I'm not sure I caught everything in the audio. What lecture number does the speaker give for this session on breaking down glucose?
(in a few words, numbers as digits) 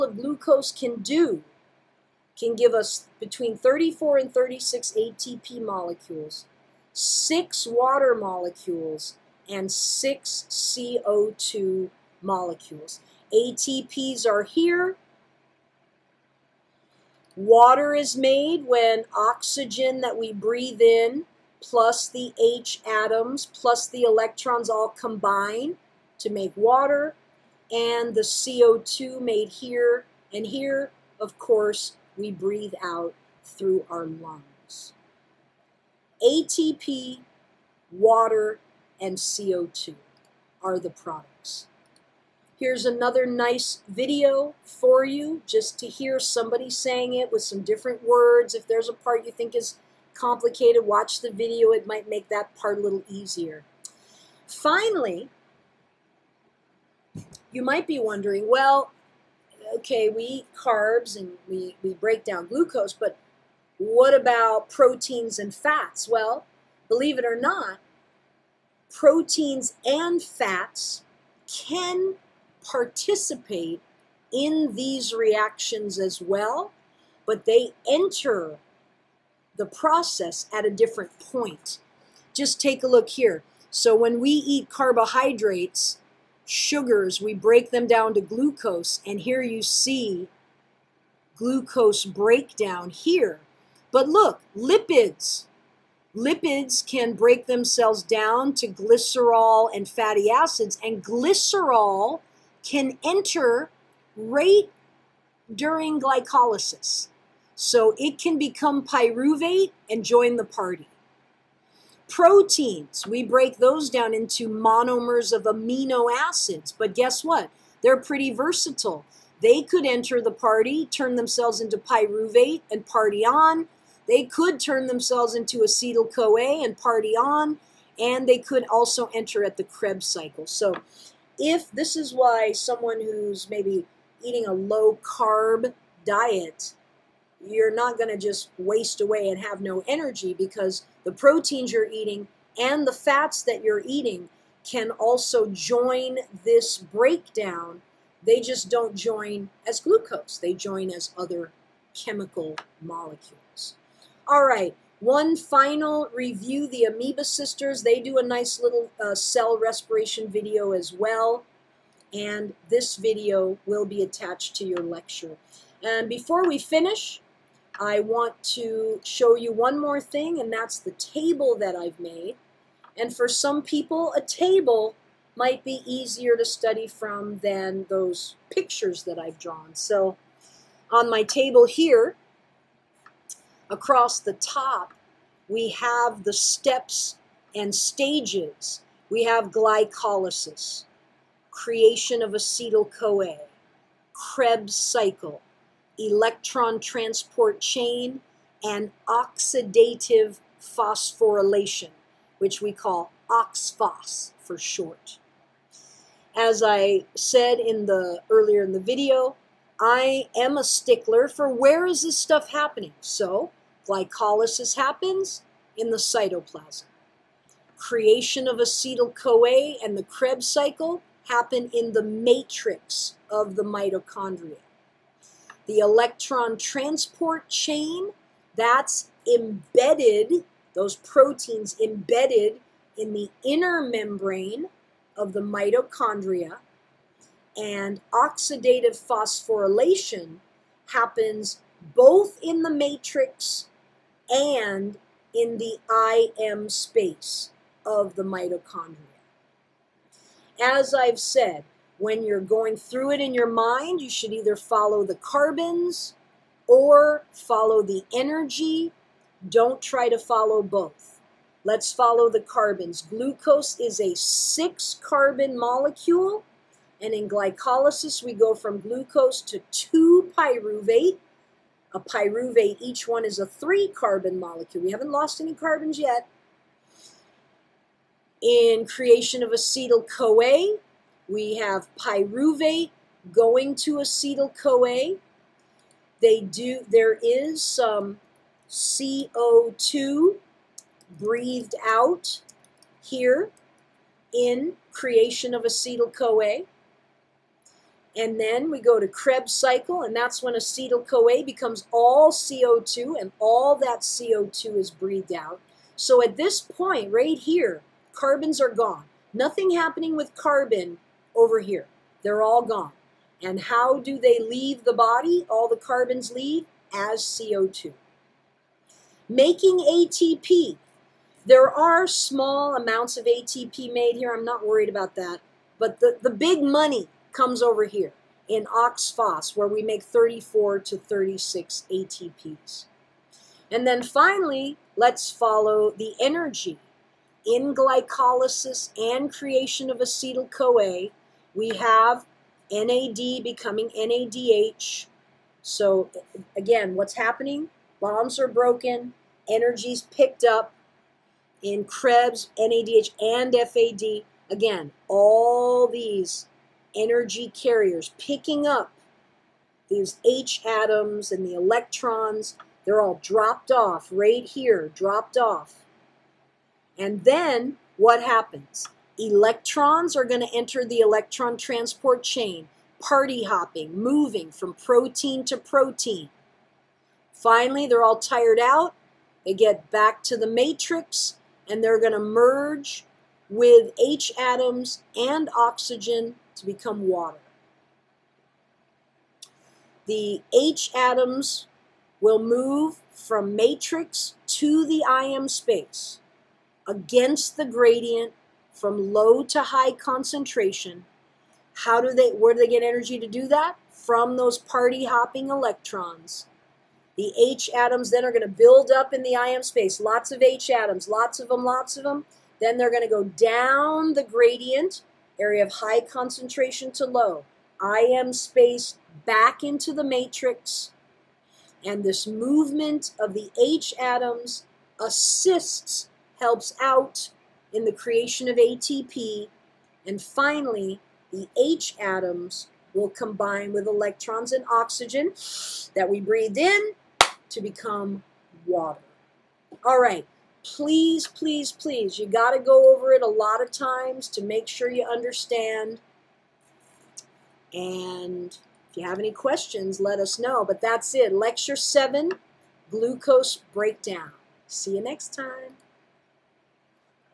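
7.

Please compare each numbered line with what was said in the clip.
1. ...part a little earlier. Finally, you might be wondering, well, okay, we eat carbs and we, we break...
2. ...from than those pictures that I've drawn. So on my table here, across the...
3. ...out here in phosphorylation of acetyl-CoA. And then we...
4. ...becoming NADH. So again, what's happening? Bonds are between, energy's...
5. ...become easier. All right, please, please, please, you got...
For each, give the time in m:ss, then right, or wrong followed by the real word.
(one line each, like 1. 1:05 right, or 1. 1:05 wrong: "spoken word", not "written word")
1. 0:52 wrong: "easier", not "earlier"
2. 2:56 right
3. 4:51 wrong: "creation", not "phosphorylation"
4. 5:43 wrong: "broken", not "between"
5. 7:17 wrong: "water", not "easier".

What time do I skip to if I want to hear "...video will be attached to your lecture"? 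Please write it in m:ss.
2:42.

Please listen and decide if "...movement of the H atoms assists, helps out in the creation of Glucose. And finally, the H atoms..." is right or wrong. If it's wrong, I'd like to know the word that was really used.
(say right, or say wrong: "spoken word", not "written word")
wrong: "ATP", not "Glucose".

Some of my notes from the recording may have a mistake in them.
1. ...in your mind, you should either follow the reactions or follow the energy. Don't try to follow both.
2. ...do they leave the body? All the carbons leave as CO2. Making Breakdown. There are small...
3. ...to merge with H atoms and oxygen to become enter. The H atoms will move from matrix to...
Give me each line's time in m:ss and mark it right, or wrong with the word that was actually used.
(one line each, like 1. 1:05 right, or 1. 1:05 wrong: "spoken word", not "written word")
1. 4:13 wrong: "carbons", not "reactions"
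2. 5:13 wrong: "ATP", not "Breakdown"
3. 6:22 wrong: "water", not "enter".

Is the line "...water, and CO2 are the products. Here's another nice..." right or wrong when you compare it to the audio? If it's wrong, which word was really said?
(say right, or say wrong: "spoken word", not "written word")
right.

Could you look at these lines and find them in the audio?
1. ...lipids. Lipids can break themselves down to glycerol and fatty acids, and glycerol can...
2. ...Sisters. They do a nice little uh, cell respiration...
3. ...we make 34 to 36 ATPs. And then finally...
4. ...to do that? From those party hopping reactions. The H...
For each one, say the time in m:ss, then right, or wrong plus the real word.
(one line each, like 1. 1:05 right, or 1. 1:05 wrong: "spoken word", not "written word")
1. 1:34 right
2. 2:37 right
3. 5:29 right
4. 6:43 wrong: "electrons", not "reactions".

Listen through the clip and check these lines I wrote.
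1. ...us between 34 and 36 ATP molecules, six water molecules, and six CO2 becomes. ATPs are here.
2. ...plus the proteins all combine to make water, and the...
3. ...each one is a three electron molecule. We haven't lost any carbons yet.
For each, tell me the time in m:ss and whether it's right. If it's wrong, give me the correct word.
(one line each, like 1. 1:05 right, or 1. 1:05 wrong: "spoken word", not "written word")
1. 0:02 wrong: "molecules", not "becomes"
2. 0:23 wrong: "electrons", not "proteins"
3. 4:32 wrong: "carbon", not "electron".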